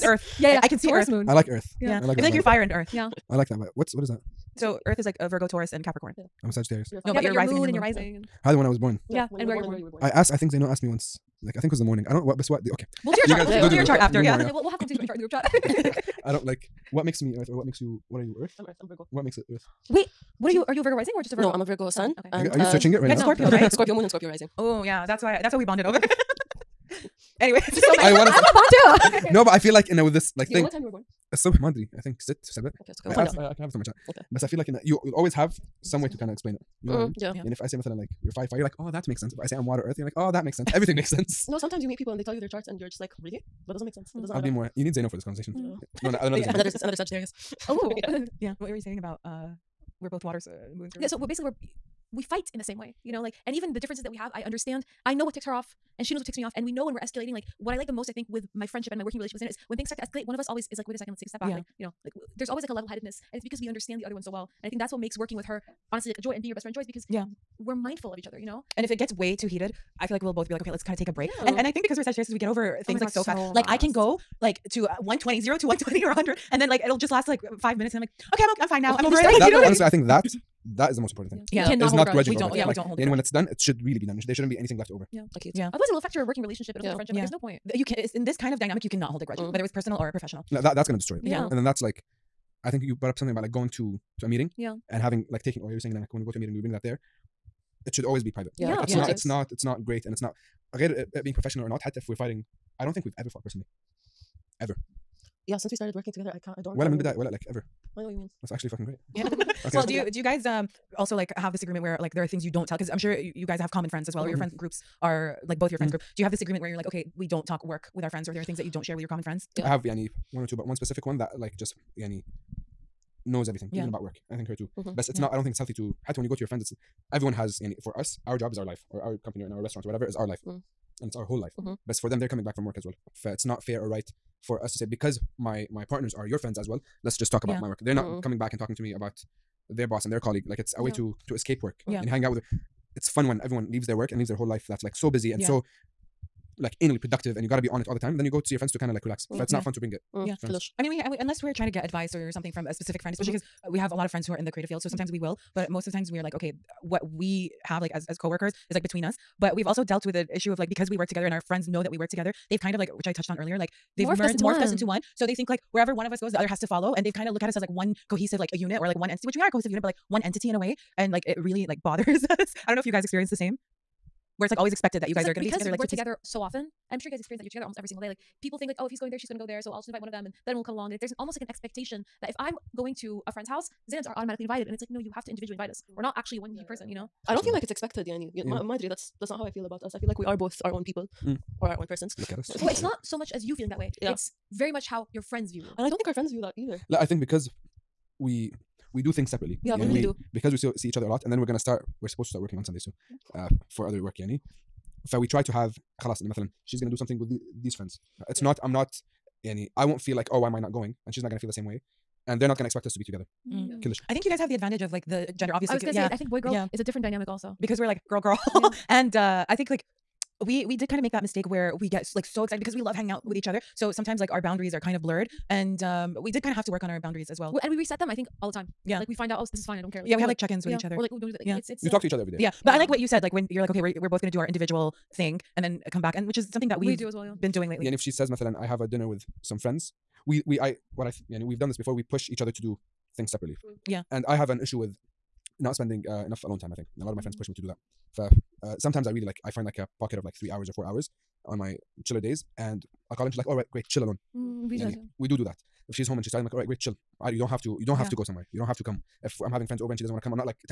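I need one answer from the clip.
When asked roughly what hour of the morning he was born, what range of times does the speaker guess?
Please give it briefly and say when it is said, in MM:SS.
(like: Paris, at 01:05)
6 or 7, at 00:32.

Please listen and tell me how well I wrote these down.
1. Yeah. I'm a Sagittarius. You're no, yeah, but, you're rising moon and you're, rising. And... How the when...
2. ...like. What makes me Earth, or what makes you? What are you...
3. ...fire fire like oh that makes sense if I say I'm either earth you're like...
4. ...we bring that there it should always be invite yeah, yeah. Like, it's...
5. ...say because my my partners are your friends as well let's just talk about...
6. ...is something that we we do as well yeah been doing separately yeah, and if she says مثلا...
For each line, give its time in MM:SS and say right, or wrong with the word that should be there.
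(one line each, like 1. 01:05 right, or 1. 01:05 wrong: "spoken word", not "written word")
1. 00:06 right
2. 00:16 right
3. 00:38 wrong: "water", not "either"
4. 01:36 wrong: "private", not "invite"
5. 02:14 right
6. 03:56 wrong: "lately", not "separately".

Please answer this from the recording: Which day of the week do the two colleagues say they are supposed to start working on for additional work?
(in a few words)
Sundays.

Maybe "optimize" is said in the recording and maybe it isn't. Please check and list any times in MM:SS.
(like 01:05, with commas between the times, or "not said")
not said.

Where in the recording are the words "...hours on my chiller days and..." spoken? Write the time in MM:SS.
04:10.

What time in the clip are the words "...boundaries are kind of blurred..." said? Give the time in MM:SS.
03:44.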